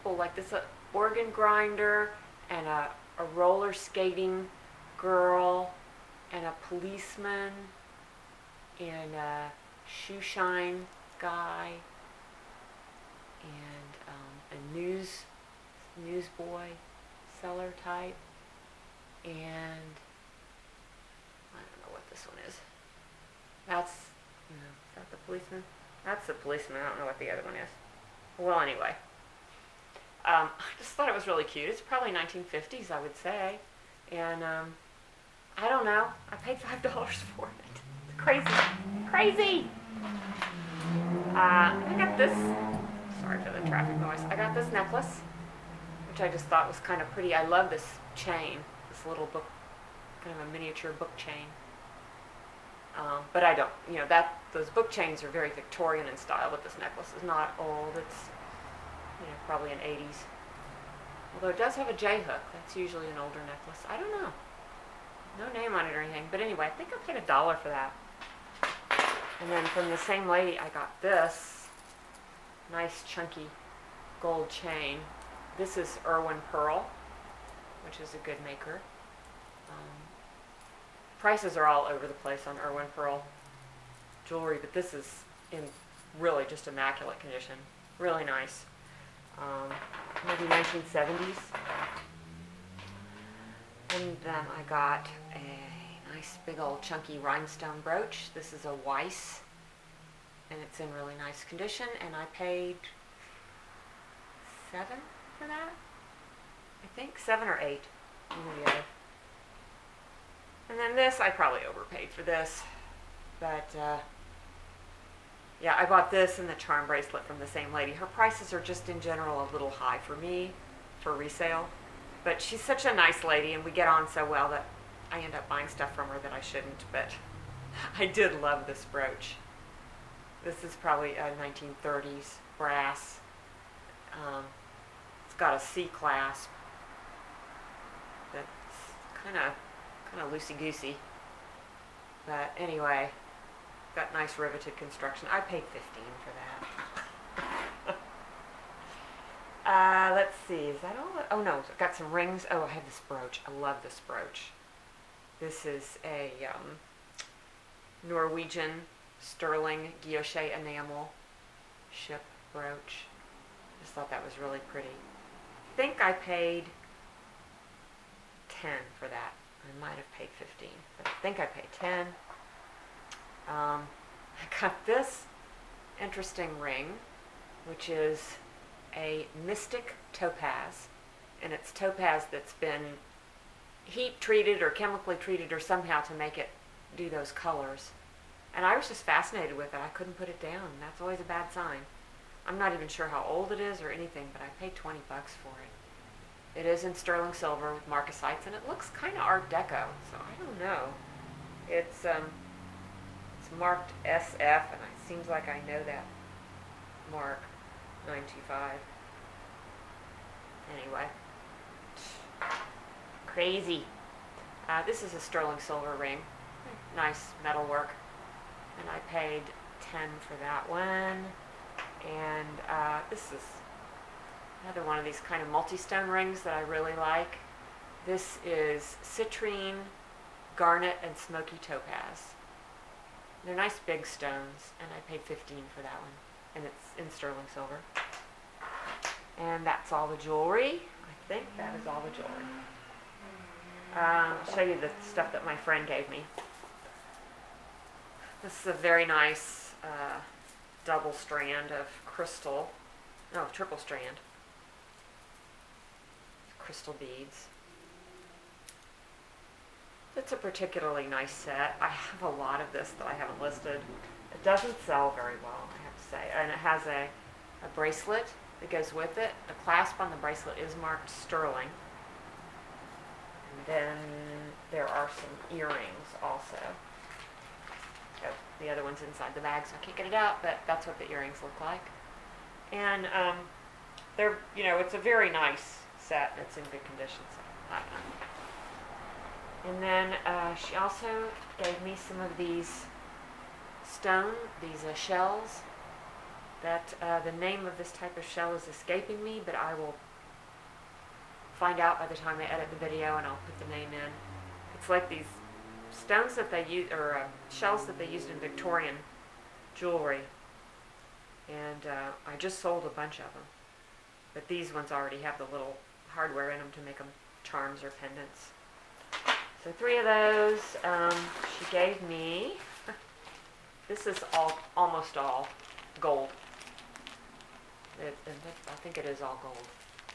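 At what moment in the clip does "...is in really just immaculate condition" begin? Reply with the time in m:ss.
1:24.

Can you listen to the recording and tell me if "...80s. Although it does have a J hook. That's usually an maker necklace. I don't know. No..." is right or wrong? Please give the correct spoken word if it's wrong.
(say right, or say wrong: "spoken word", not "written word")
wrong: "older", not "maker".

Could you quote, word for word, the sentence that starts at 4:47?
So and then uh, she also gave me some of these stone, these uh, shells.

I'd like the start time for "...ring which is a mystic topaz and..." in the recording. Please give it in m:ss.
2:56.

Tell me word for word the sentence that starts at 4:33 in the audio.
And then there are some earrings also.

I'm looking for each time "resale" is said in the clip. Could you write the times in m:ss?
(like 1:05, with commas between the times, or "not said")
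2:01.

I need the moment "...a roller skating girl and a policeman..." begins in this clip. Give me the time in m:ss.
0:03.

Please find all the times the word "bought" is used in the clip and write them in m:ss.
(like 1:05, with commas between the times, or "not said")
1:55.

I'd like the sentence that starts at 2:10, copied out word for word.
This is probably a 1930s brass.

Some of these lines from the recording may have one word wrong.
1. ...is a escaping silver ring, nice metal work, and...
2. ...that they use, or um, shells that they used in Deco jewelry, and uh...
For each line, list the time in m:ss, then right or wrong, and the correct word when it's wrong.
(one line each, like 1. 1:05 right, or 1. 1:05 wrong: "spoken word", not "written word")
1. 3:35 wrong: "sterling", not "escaping"
2. 5:06 wrong: "Victorian", not "Deco".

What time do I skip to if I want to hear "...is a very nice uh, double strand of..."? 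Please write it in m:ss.
4:08.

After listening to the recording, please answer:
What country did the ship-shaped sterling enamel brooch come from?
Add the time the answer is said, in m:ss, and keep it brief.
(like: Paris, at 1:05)
Norwegian, at 2:38.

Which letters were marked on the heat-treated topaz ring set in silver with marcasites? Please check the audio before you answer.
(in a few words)
SF.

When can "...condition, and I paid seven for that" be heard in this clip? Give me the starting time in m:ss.
1:41.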